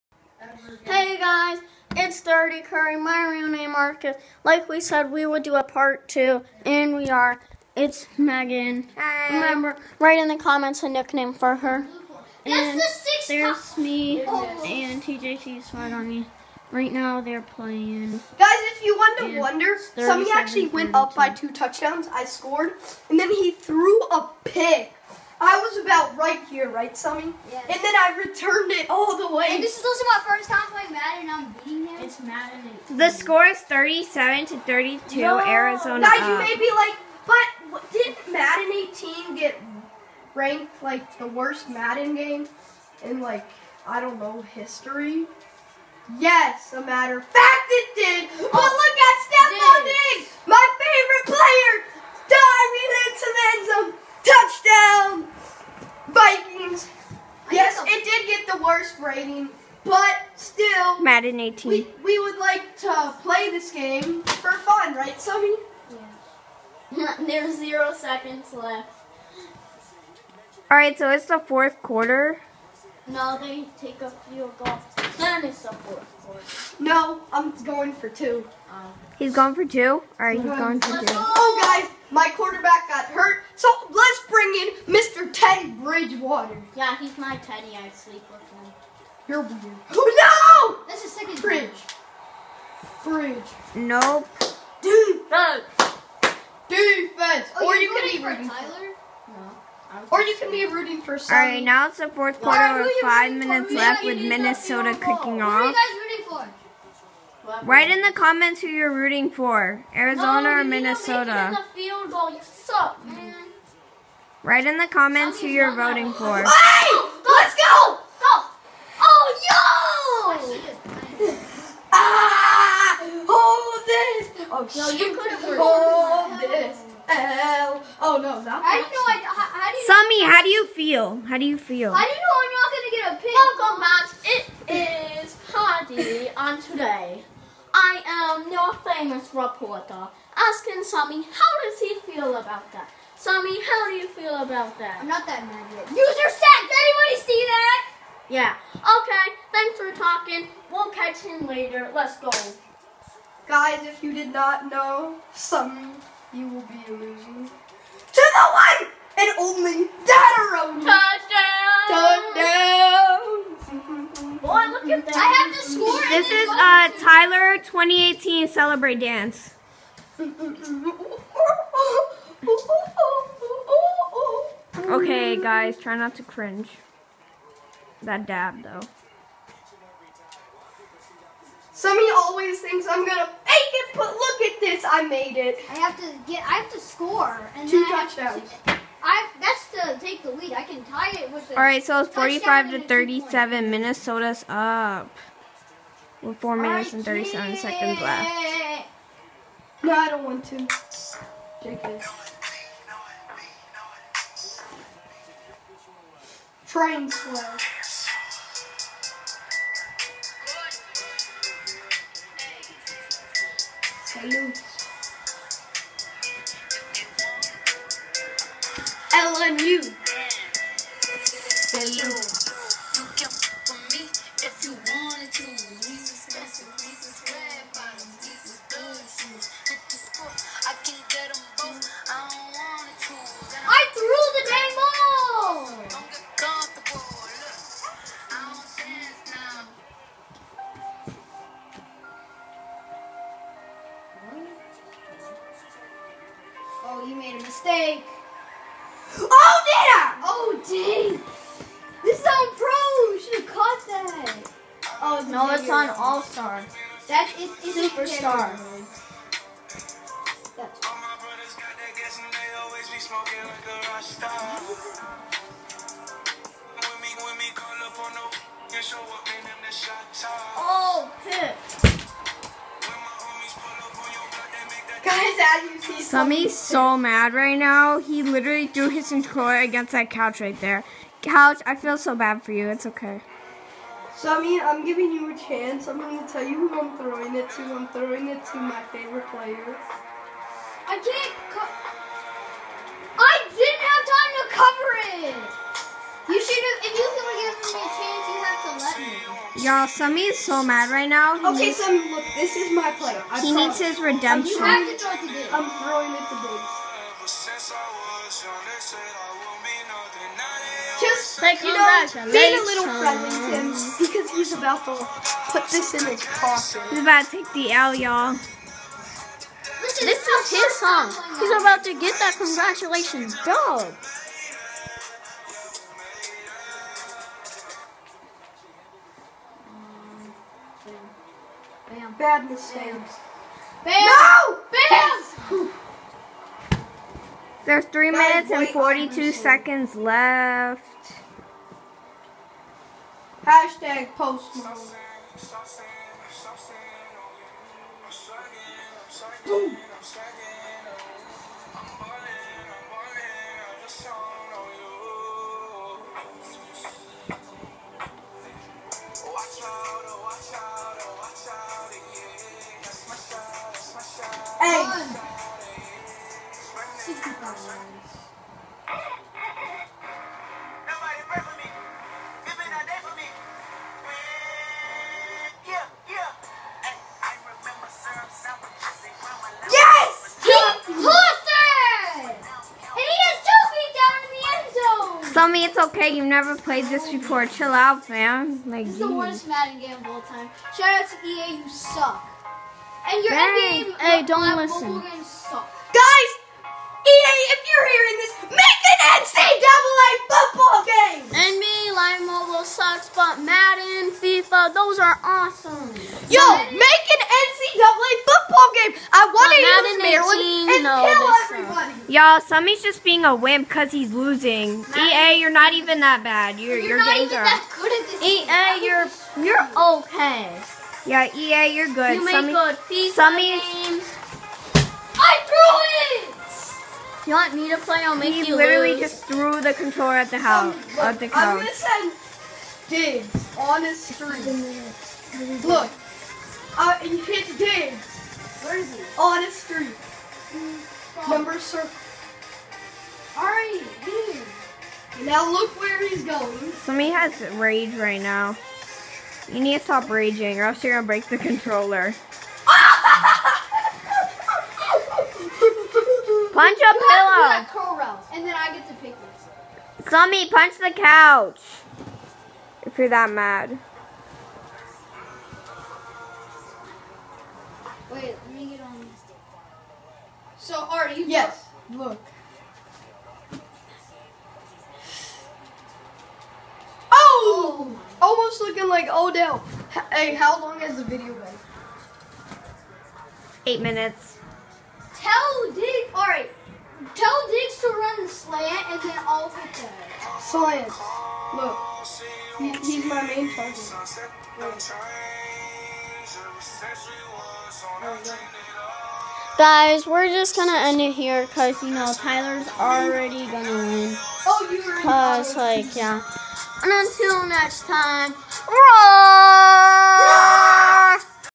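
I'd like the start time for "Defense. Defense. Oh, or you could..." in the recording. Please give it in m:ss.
1:34.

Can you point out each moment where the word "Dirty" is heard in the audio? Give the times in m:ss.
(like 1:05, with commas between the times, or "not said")
0:02.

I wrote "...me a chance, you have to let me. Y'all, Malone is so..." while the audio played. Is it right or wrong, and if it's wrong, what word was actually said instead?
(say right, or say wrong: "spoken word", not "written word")
wrong: "Sammy", not "Malone".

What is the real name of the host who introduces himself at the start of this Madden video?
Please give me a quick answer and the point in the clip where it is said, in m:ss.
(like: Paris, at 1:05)
Marcus, at 0:03.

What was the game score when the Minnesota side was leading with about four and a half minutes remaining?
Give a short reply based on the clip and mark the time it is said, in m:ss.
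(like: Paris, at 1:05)
45 to 37, at 3:12.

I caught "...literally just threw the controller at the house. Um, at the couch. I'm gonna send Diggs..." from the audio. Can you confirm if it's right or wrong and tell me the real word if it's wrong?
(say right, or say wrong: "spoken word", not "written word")
right.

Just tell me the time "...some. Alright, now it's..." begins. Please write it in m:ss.
1:41.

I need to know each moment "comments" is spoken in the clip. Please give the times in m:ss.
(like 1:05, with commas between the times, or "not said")
0:10, 1:48, 1:54.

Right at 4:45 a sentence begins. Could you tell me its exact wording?
I'm going to tell you who I'm throwing it to.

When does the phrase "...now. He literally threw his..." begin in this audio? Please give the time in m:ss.
4:37.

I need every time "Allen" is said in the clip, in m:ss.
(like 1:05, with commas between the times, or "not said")
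not said.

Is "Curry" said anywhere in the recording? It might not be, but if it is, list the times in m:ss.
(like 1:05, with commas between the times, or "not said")
0:02.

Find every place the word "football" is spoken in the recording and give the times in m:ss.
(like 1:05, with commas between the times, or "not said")
6:40, 6:48.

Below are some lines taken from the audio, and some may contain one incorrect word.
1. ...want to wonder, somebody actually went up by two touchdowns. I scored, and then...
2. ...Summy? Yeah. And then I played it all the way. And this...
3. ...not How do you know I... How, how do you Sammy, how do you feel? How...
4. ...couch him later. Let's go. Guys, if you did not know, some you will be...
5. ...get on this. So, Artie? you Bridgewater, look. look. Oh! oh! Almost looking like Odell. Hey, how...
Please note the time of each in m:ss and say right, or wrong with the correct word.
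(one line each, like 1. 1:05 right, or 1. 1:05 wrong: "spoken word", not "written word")
1. 0:18 right
2. 0:26 wrong: "returned", not "played"
3. 2:08 right
4. 2:30 wrong: "catch", not "couch"
5. 7:48 wrong: "Yes", not "Bridgewater".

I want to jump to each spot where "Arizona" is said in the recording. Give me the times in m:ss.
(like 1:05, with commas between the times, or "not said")
0:35, 1:49.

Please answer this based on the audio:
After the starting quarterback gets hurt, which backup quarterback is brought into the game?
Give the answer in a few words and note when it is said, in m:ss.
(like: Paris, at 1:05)
Teddy Bridgewater, at 1:25.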